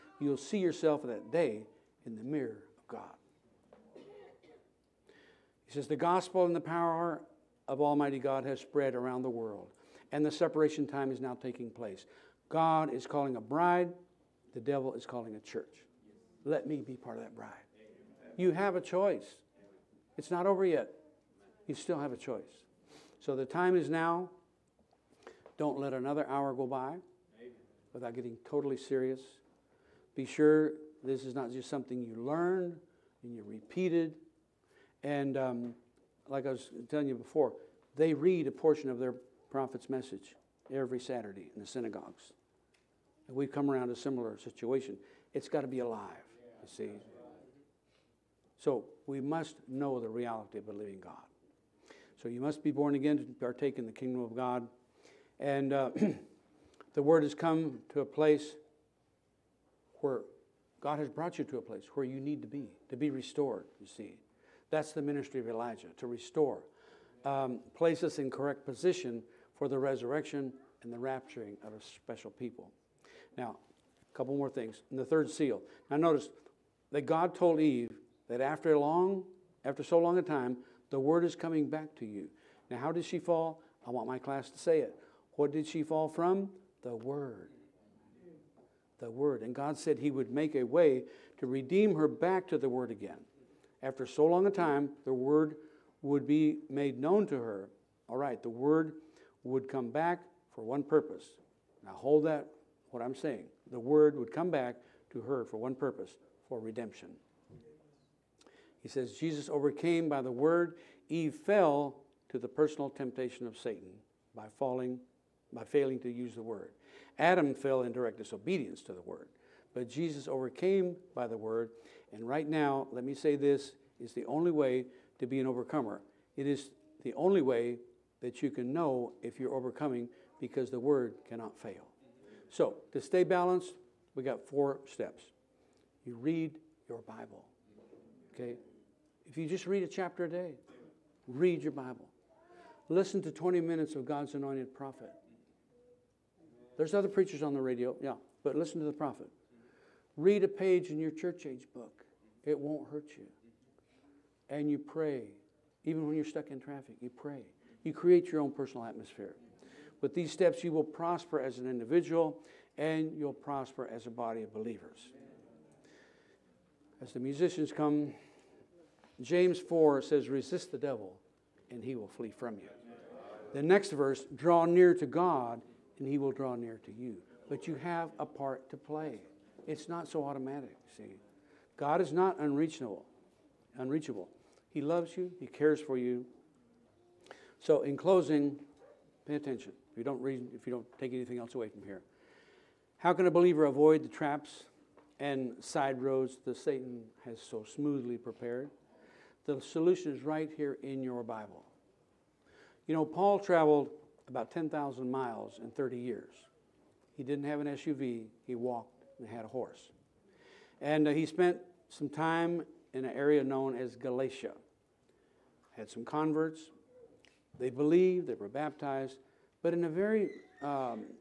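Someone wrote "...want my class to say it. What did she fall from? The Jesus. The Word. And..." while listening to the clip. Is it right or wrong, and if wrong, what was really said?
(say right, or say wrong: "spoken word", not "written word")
wrong: "Word", not "Jesus".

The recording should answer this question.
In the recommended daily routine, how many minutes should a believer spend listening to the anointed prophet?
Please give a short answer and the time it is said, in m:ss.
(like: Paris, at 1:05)
20, at 2:23.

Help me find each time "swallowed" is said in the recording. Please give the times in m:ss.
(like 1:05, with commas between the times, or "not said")
not said.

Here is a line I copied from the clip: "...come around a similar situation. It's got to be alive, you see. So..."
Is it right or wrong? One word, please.
right.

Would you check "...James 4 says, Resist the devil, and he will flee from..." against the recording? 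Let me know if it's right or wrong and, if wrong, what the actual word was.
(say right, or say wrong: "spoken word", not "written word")
right.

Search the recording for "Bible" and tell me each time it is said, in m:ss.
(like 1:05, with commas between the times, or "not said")
2:17, 2:21, 3:21.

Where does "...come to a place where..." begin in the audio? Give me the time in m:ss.
0:57.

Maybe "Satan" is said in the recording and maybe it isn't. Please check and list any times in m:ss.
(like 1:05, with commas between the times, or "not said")
1:53, 3:16.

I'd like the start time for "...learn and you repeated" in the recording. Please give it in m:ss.
0:32.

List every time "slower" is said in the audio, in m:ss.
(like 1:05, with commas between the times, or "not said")
not said.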